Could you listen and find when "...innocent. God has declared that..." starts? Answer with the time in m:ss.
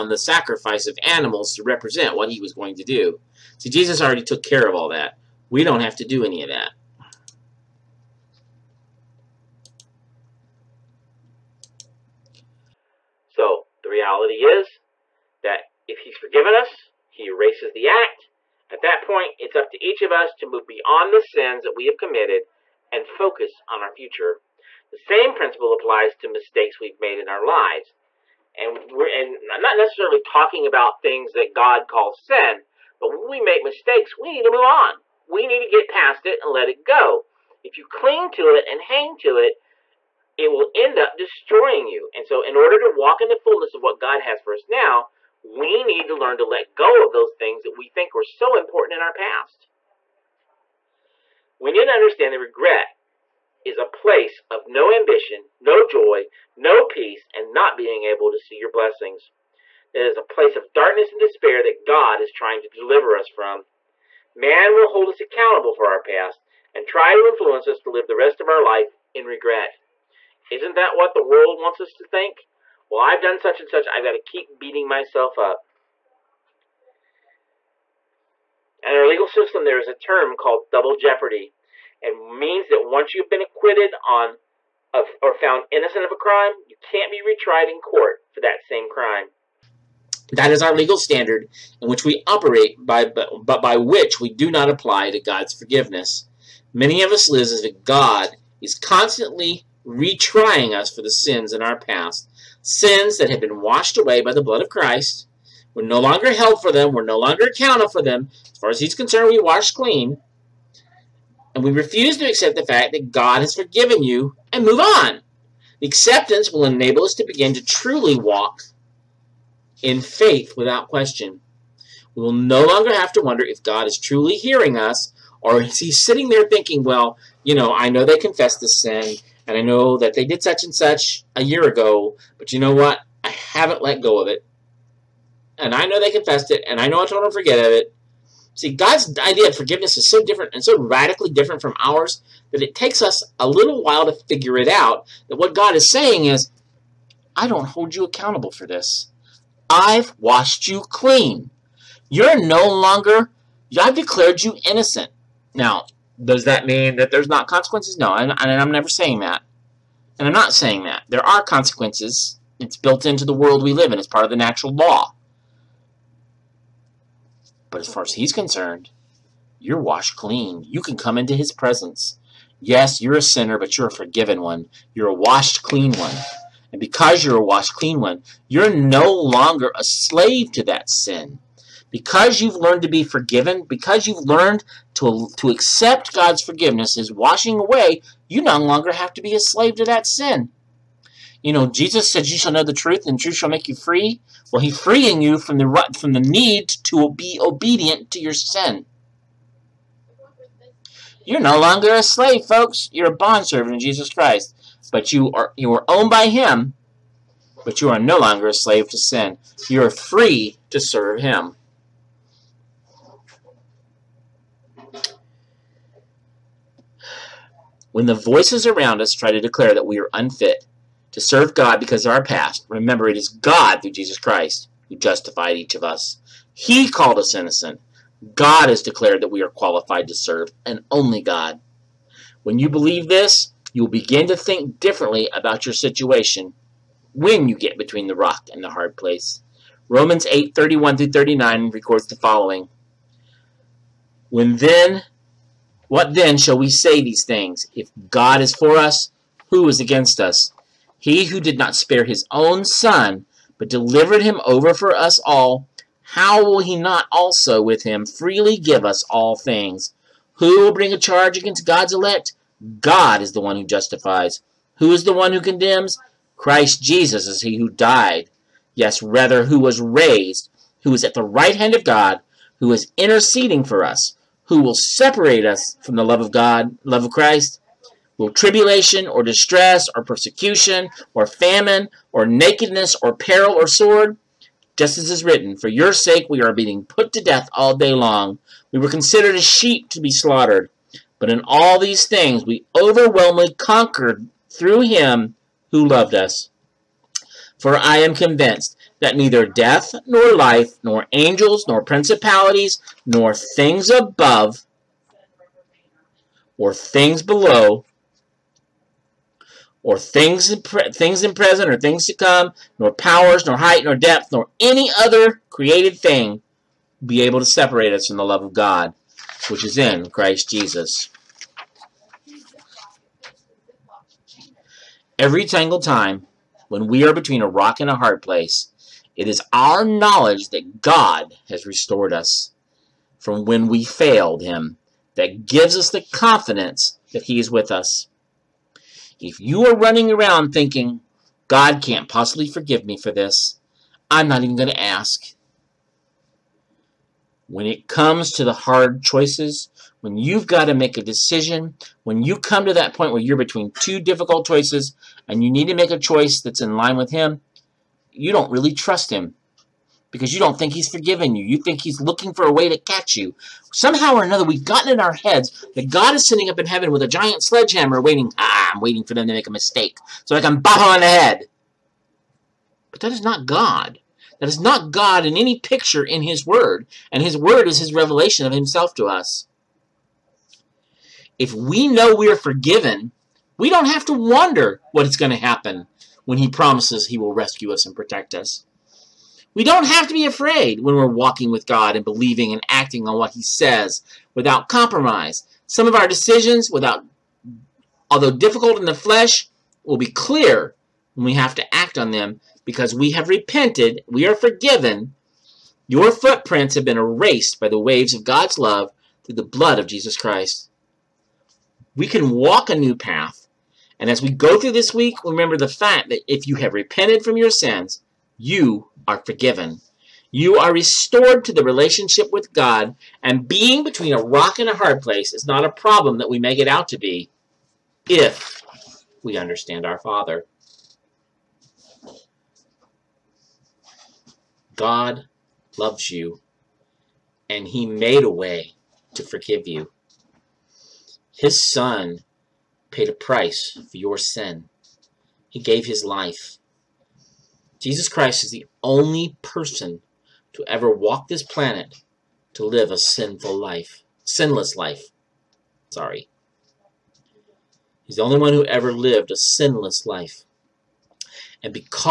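3:47.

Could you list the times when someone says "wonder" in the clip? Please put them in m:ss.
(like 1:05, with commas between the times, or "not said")
2:03, 6:24.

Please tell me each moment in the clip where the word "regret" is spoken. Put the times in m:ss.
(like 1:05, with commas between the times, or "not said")
0:52, 1:09.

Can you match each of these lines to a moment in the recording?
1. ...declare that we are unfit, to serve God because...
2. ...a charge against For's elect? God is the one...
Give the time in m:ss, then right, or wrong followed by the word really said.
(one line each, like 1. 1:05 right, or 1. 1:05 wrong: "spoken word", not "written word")
1. 3:39 right
2. 4:20 wrong: "God", not "For".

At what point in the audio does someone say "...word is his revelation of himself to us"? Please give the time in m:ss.
6:17.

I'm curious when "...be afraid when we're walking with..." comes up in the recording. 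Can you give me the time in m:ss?
6:30.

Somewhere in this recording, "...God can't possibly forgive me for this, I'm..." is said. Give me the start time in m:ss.
5:41.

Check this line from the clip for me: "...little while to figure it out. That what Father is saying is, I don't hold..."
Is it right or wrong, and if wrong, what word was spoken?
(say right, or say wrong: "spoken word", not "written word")
wrong: "God", not "Father".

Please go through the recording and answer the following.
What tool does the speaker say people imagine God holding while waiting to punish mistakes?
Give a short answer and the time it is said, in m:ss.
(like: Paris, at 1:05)
sledgehammer, at 6:07.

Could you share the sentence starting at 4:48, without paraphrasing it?
We were considered as sheep to be slaughtered.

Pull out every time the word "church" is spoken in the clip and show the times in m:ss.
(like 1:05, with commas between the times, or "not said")
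not said.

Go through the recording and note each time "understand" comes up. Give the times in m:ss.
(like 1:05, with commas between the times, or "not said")
0:51, 7:09.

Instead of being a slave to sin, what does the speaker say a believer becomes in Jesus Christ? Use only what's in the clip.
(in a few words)
a bondservant.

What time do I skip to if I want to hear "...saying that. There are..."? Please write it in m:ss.
2:40.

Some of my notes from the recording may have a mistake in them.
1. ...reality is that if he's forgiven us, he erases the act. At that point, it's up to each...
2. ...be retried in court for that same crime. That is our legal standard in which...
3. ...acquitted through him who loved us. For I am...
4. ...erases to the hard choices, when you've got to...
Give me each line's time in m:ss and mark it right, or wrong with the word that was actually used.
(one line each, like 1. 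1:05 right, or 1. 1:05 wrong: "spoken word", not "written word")
1. 0:13 right
2. 1:27 right
3. 4:53 wrong: "conquered", not "acquitted"
4. 5:47 wrong: "comes", not "erases".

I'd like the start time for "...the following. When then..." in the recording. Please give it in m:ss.
4:02.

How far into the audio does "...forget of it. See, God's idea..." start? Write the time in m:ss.
2:17.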